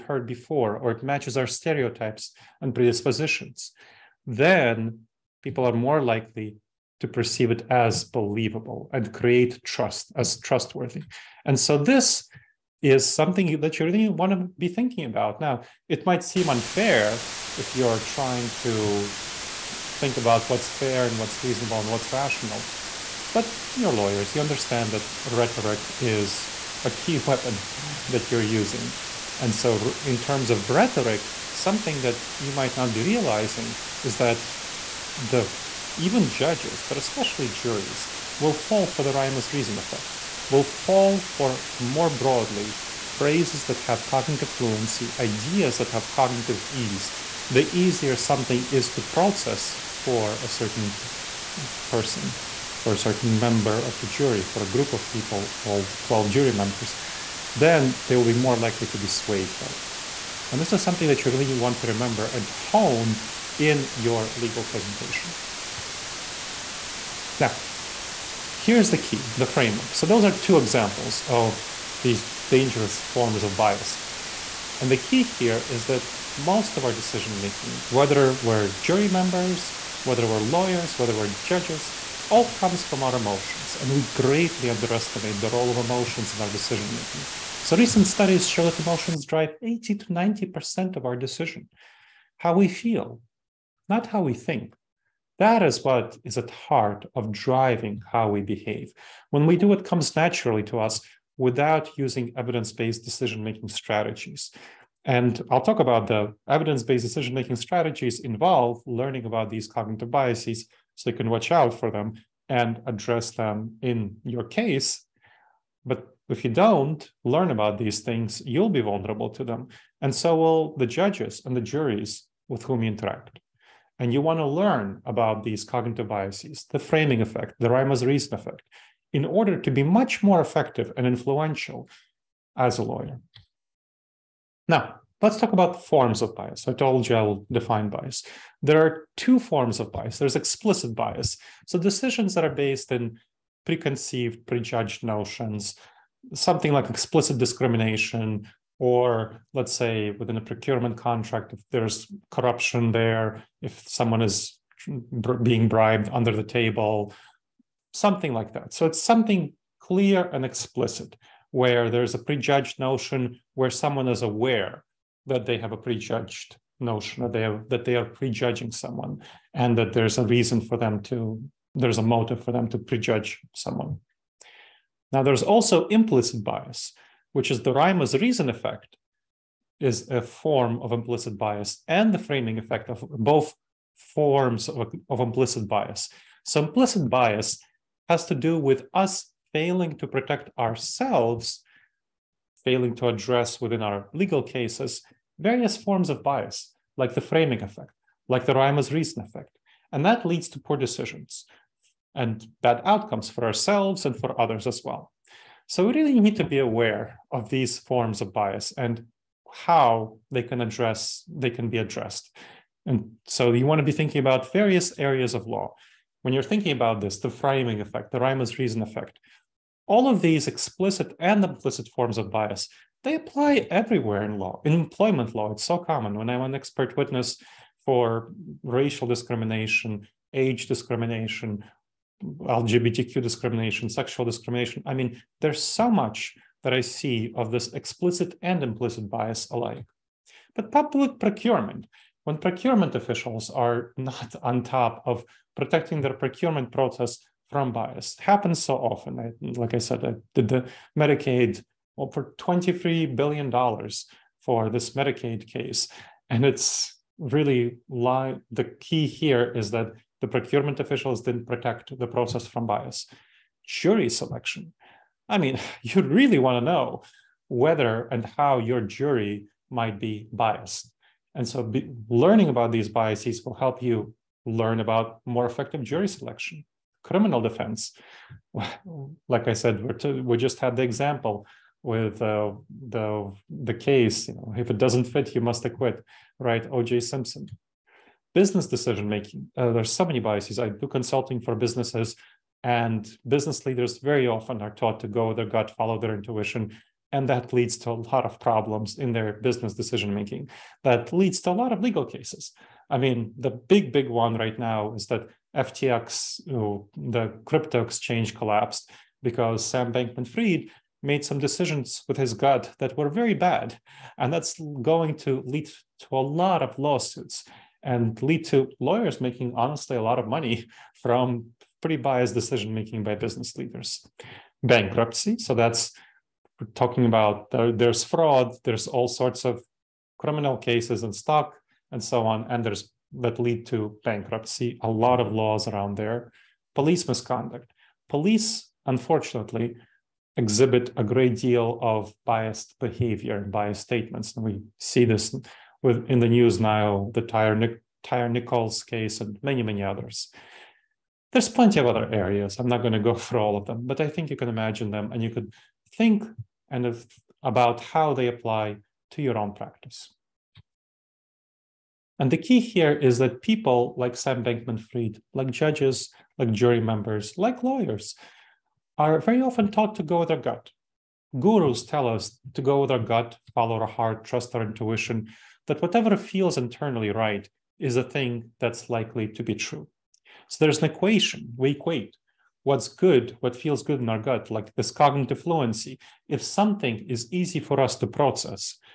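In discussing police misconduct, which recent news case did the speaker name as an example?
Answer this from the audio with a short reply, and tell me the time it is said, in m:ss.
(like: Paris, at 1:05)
Tyre Nichols, at 5:48.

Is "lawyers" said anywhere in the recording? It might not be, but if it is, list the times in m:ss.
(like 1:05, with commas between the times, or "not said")
0:23, 1:20, 2:12, 5:18, 6:07.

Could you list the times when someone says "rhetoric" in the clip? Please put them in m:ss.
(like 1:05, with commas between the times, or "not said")
0:25, 0:30.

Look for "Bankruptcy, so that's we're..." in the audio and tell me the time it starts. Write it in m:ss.
5:24.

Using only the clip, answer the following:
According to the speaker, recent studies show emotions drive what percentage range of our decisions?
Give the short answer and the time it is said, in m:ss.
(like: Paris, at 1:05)
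80 to 90%, at 1:29.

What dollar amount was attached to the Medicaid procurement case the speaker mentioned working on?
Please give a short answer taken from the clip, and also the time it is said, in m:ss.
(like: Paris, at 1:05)
$23 billion, at 4:12.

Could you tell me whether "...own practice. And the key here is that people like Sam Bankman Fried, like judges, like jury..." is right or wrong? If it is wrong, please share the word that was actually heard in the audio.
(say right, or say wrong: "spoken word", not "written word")
right.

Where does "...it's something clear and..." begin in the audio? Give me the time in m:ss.
2:38.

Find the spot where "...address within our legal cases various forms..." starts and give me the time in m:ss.
3:13.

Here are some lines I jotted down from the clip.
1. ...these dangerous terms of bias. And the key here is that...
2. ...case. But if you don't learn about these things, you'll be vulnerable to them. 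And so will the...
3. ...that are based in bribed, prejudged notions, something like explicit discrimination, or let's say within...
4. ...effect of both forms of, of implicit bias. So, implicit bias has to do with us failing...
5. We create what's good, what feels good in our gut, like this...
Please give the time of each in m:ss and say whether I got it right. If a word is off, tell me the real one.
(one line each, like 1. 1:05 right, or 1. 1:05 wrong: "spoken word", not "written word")
1. 1:12 wrong: "forms", not "terms"
2. 1:54 right
3. 2:22 wrong: "preconceived", not "bribed"
4. 3:02 right
5. 6:21 wrong: "equate", not "create".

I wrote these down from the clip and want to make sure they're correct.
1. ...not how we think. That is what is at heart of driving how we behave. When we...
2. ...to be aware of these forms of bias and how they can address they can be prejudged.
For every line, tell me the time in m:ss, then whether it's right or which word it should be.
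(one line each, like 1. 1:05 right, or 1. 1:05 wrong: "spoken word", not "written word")
1. 1:33 right
2. 3:26 wrong: "addressed", not "prejudged".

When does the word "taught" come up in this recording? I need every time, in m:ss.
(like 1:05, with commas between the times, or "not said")
4:54, 6:09.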